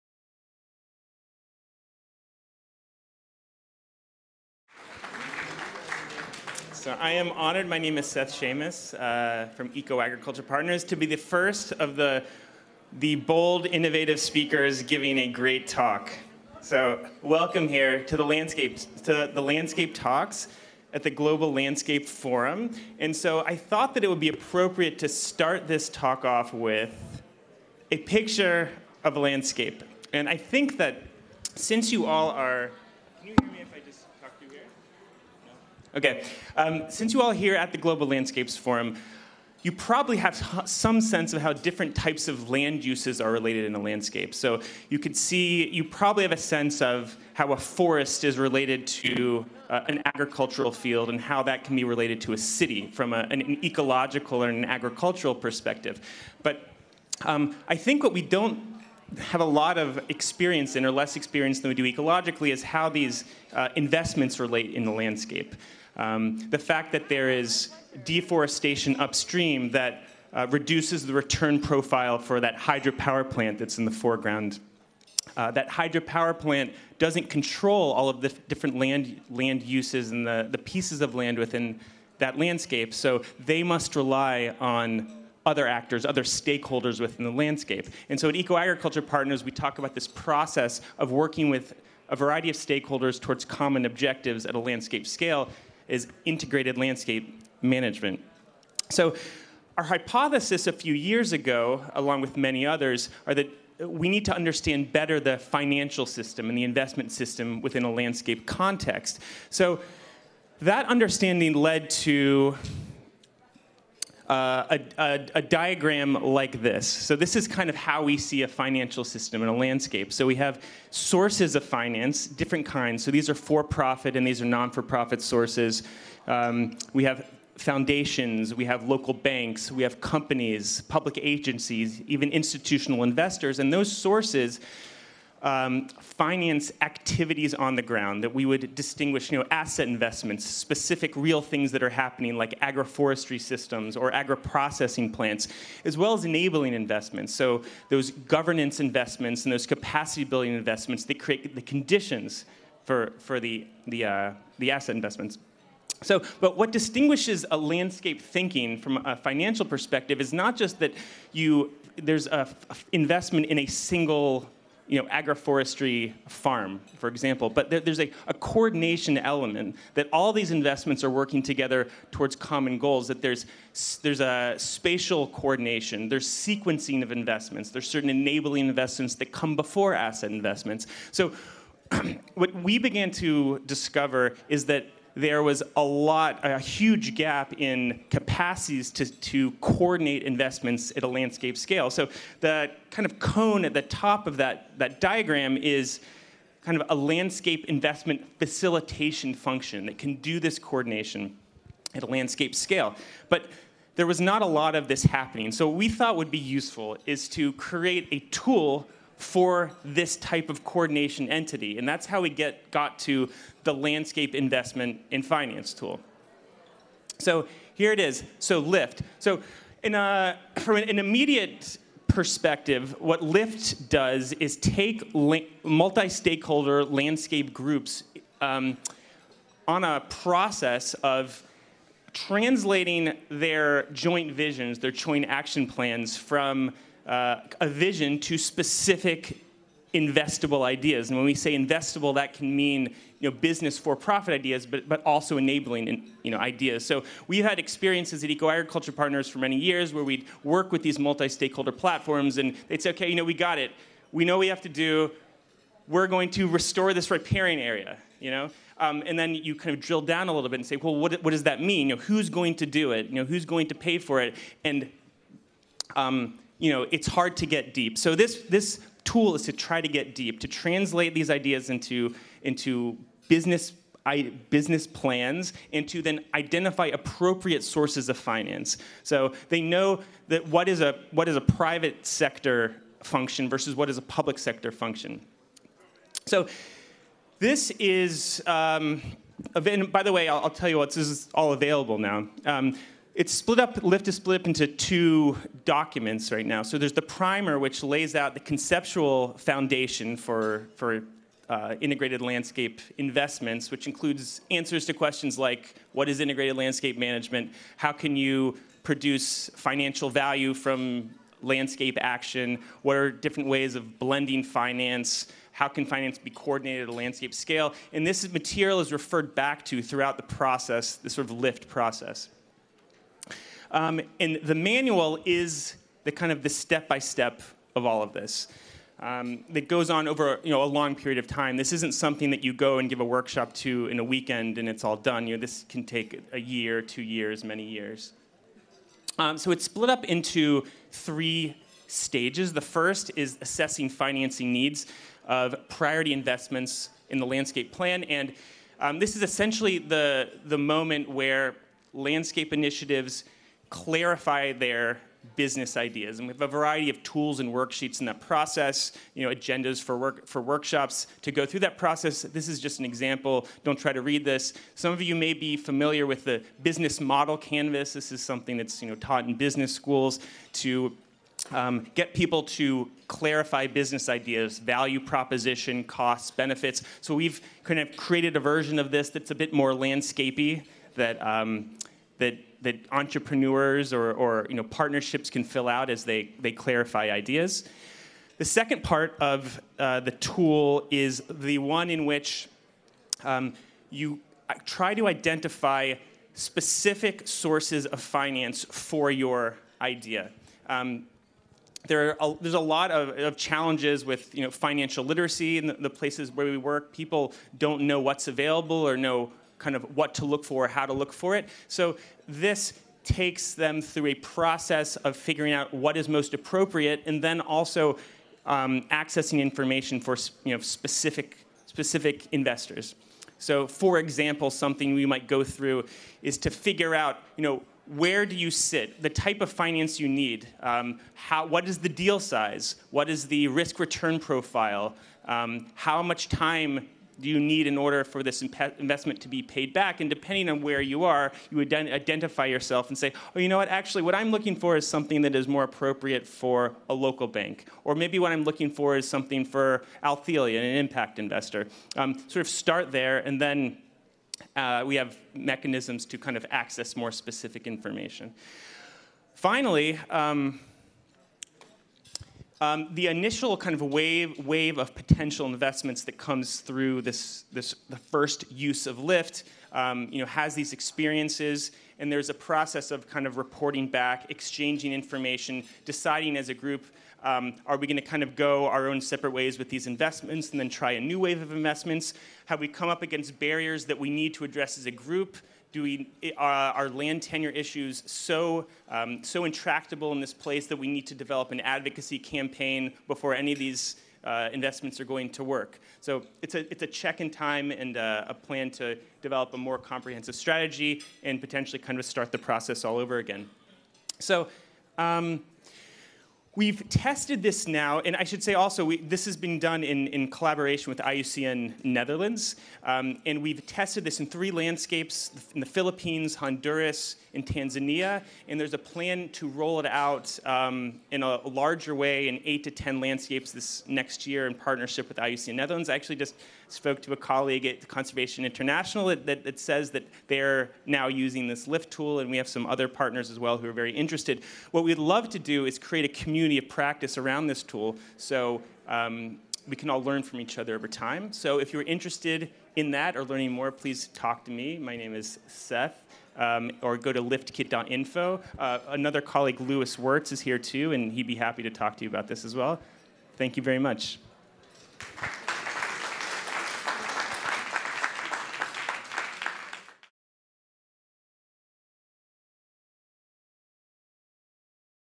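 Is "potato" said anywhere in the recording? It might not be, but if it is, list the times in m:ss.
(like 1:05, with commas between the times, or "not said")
not said.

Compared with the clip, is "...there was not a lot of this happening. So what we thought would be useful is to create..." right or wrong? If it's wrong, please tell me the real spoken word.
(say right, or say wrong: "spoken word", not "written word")
right.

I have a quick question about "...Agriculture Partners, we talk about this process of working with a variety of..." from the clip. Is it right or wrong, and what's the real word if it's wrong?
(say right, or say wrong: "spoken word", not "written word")
right.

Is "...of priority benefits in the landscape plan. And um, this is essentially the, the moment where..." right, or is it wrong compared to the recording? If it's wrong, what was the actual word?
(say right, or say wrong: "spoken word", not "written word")
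wrong: "investments", not "benefits".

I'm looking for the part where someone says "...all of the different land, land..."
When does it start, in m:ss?
1:17.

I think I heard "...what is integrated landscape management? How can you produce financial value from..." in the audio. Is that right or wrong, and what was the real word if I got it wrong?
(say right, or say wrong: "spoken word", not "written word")
right.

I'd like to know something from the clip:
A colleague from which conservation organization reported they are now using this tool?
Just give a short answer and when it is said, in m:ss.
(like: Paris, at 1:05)
Conservation International, at 8:47.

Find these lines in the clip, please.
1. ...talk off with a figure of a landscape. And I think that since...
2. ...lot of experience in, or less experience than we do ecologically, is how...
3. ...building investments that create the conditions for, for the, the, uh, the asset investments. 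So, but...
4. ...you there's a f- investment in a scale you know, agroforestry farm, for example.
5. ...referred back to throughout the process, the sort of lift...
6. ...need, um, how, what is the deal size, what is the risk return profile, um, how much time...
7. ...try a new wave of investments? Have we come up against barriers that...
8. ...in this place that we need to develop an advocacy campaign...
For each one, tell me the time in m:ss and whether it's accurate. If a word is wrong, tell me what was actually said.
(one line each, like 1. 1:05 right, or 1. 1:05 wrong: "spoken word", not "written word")
1. 0:25 wrong: "picture", not "figure"
2. 0:59 right
3. 2:30 right
4. 2:41 wrong: "single", not "scale"
5. 5:18 right
6. 7:10 right
7. 8:00 right
8. 8:10 right.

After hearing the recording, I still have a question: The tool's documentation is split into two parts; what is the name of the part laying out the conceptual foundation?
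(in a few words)
primer.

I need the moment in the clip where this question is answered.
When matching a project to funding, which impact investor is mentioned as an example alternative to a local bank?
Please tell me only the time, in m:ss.
7:30.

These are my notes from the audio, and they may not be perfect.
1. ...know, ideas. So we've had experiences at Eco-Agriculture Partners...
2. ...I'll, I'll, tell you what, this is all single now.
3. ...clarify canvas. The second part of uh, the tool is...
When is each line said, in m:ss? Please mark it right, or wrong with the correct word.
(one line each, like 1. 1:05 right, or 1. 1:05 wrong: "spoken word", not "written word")
1. 4:06 right
2. 4:50 wrong: "available", not "single"
3. 6:26 wrong: "ideas", not "canvas".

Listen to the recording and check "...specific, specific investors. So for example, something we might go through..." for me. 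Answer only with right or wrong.
right.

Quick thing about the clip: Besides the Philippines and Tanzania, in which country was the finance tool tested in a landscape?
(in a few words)
Honduras.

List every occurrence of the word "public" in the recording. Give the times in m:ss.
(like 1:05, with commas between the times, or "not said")
2:10, 4:44.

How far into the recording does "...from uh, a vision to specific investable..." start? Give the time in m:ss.
3:56.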